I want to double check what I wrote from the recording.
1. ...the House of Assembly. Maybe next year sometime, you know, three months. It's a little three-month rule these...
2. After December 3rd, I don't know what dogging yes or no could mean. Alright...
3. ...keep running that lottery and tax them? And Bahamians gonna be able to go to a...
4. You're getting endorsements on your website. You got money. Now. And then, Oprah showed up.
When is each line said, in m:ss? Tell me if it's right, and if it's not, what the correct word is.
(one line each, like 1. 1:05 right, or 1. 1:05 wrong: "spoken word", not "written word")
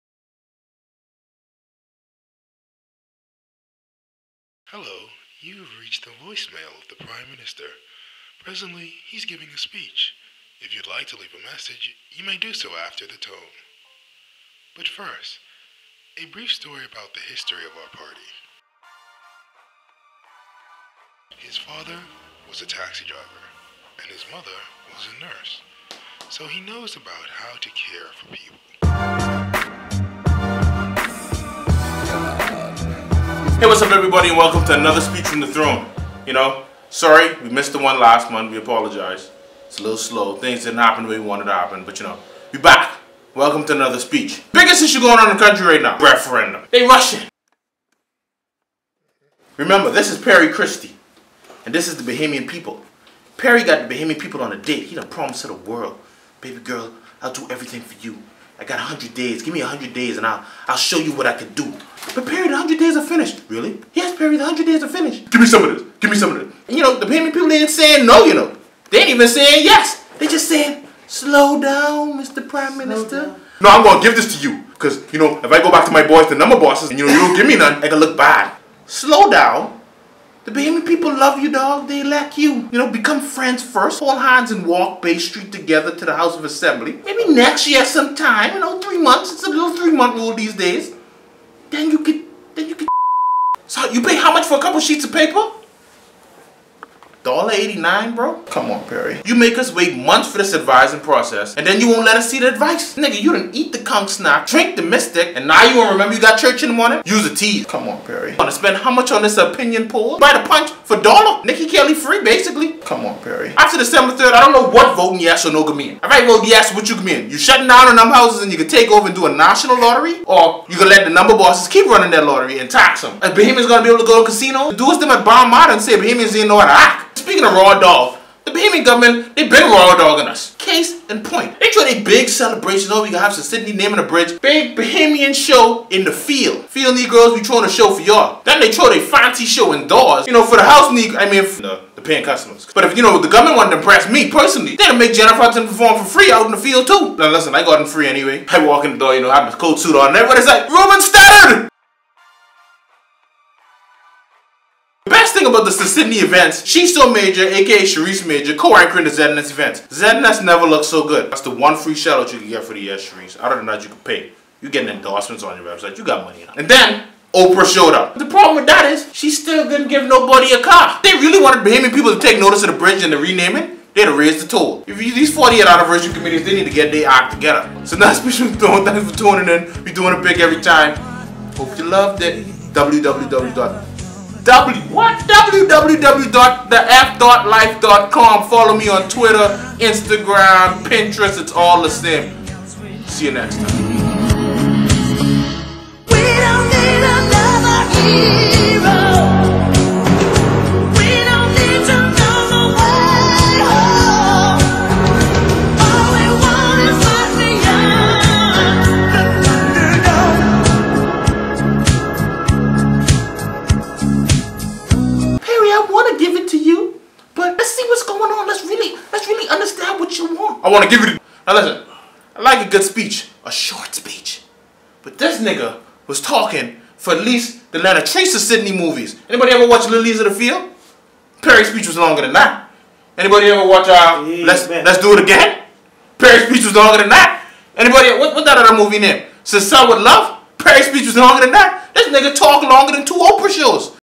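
1. 1:26 right
2. 1:53 wrong: "voting", not "dogging"
3. 2:01 right
4. 2:44 right.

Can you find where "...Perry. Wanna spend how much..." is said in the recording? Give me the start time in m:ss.
1:48.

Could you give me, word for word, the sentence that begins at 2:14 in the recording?
Big Bahamian show in the field.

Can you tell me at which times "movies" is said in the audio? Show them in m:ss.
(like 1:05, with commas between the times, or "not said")
3:48, 3:58.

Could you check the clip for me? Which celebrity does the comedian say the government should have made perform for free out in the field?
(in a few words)
Jennifer Hudson.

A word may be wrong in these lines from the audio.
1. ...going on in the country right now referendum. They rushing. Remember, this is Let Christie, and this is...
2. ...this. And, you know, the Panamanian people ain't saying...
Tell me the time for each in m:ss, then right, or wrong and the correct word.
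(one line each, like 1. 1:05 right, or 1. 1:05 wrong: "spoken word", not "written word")
1. 0:44 wrong: "Perry", not "Let"
2. 1:06 right.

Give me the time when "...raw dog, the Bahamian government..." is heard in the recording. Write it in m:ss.
2:07.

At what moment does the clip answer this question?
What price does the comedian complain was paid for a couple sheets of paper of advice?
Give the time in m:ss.
1:37.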